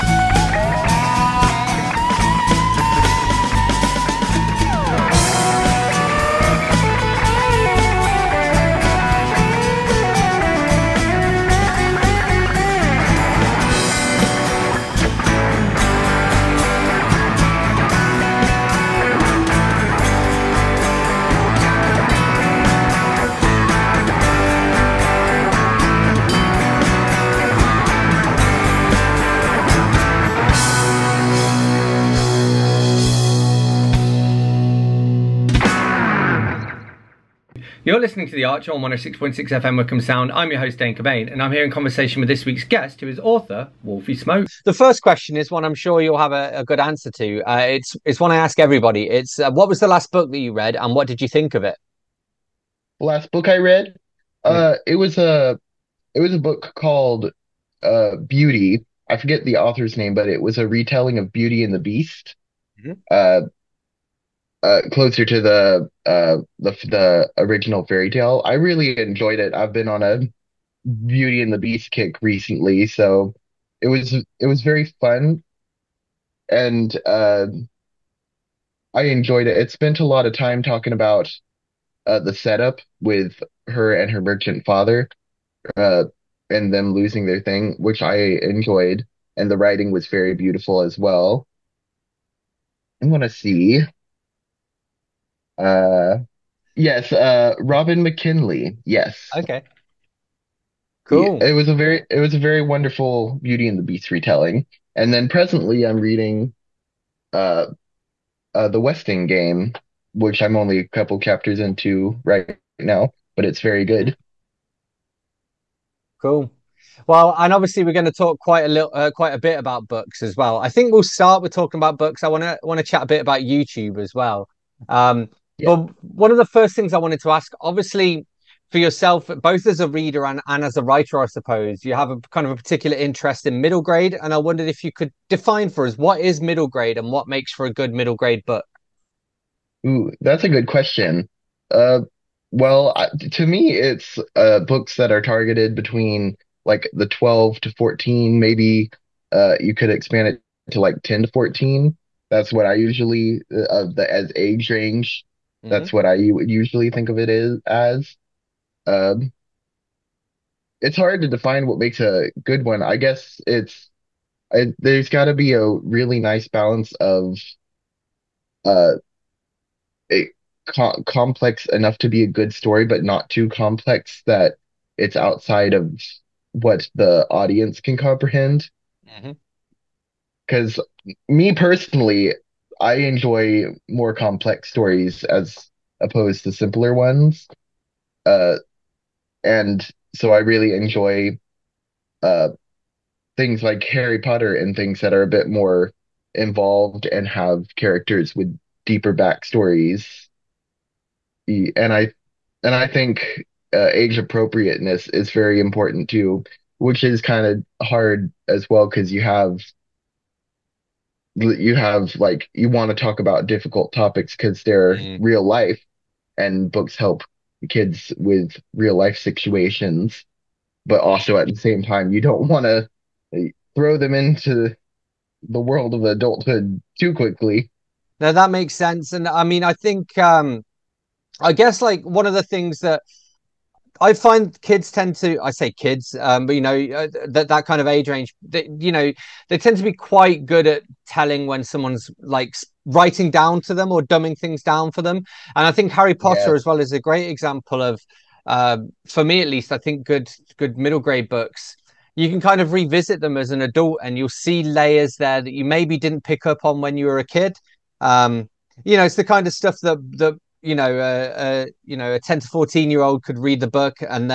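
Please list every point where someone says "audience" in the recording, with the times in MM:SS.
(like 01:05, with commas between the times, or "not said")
02:57.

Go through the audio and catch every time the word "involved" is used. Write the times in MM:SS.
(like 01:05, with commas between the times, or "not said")
03:16.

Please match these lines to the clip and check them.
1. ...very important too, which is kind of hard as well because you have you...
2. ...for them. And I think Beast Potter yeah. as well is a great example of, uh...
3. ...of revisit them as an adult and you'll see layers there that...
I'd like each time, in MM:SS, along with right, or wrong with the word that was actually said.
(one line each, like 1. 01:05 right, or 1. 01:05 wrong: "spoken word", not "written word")
1. 03:25 right
2. 04:04 wrong: "Harry", not "Beast"
3. 04:12 right.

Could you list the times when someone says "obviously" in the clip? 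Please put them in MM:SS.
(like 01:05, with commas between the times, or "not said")
01:57, 02:07.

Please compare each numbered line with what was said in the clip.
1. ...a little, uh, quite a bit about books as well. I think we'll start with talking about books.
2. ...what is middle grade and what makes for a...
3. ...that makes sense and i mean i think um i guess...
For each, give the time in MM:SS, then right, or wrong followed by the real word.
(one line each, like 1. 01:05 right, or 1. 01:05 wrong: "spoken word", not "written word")
1. 01:58 right
2. 02:15 right
3. 03:48 right.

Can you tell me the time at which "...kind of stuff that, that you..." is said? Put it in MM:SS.
04:19.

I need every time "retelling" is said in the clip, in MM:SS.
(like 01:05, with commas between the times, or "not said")
01:00, 01:44.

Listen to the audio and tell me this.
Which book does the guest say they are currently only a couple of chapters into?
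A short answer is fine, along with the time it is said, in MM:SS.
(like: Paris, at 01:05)
The Westing Game, at 01:48.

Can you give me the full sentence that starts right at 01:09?
I've been on a Beauty and the Beast kick recently, so it was it was very fun, and uh, I enjoyed it.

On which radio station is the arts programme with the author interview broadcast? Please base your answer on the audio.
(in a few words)
Wycombe Sound.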